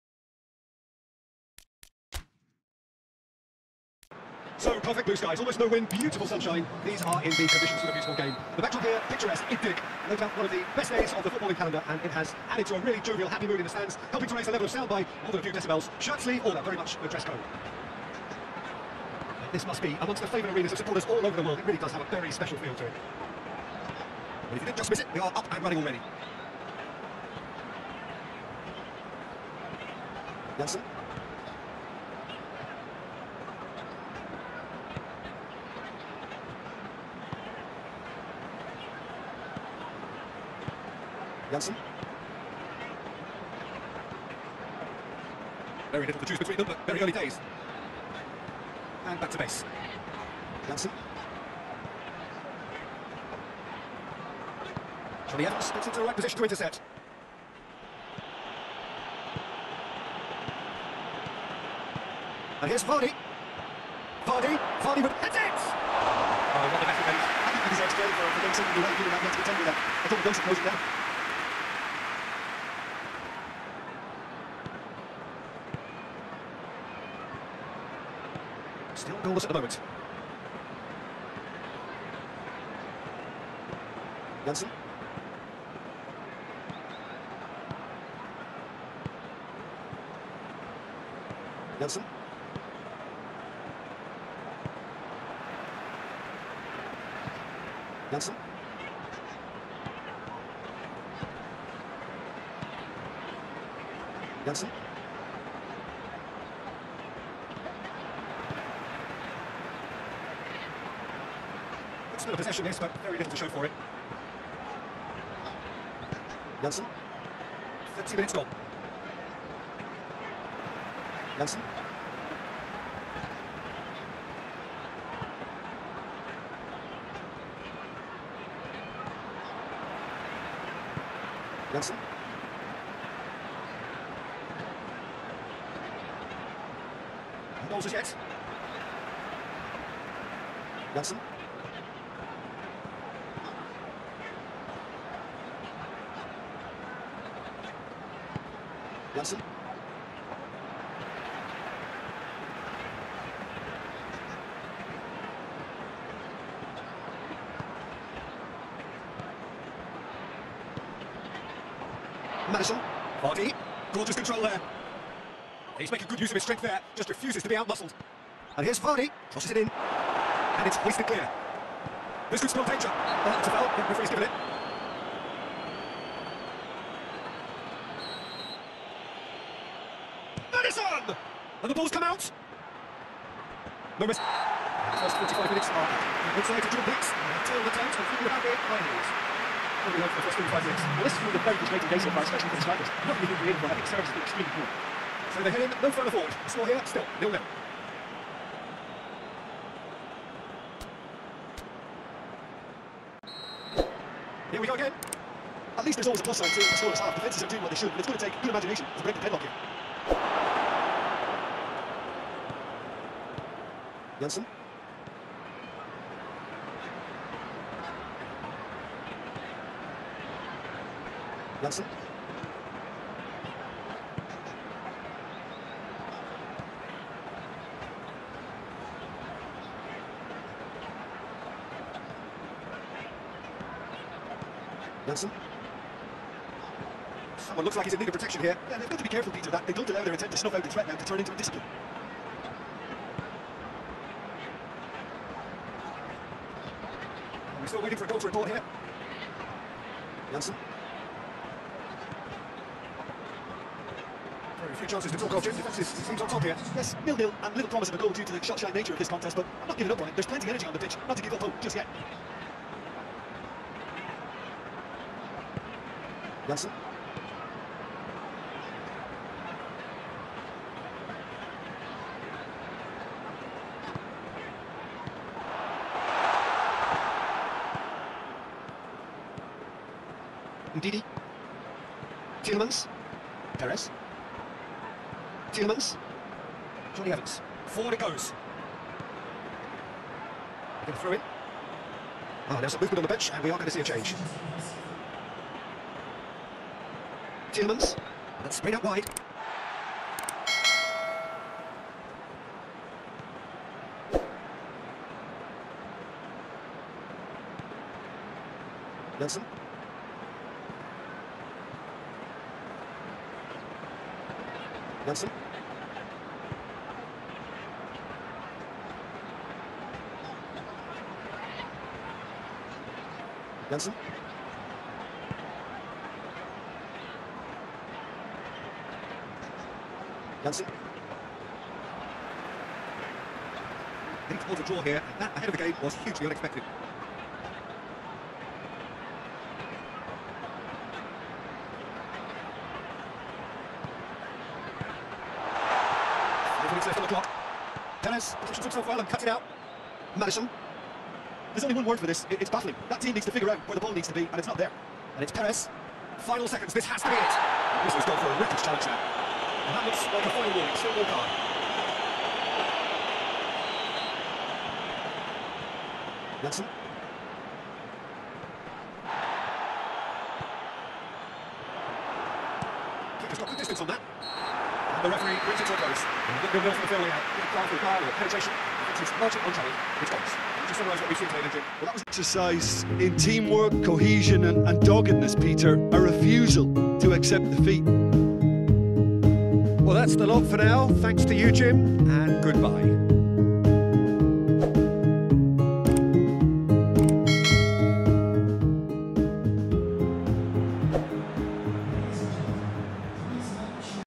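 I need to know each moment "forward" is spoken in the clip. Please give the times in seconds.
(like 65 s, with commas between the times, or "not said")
196 s, 287 s.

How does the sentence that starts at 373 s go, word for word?
has got good distance on that.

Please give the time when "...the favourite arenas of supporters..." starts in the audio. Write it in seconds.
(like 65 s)
20 s.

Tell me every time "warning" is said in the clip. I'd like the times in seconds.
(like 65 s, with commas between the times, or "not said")
360 s.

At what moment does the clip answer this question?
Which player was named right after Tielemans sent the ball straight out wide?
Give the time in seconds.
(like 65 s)
309 s.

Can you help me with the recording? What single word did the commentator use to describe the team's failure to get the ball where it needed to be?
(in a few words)
baffling.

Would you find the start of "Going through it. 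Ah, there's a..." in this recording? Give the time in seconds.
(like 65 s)
290 s.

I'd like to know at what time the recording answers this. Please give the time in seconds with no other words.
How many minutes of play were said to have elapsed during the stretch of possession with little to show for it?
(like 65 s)
117 s.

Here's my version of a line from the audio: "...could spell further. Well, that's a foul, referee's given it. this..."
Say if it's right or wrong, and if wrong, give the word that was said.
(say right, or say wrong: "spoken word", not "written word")
wrong: "danger", not "further".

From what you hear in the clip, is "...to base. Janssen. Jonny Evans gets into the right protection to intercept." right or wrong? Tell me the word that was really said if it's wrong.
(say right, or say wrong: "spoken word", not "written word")
wrong: "position", not "protection".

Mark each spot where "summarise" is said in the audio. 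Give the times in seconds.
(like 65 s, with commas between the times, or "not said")
380 s.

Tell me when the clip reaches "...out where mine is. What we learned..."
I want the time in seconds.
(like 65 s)
188 s.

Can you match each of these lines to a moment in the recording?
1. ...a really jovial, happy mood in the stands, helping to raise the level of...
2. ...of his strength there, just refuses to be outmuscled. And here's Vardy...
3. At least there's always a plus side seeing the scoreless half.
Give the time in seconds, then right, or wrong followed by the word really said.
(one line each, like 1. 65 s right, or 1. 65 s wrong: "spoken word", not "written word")
1. 12 s right
2. 166 s right
3. 205 s right.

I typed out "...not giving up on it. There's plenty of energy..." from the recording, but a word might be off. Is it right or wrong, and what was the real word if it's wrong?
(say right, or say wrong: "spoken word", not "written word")
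right.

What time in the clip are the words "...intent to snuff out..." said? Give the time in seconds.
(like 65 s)
240 s.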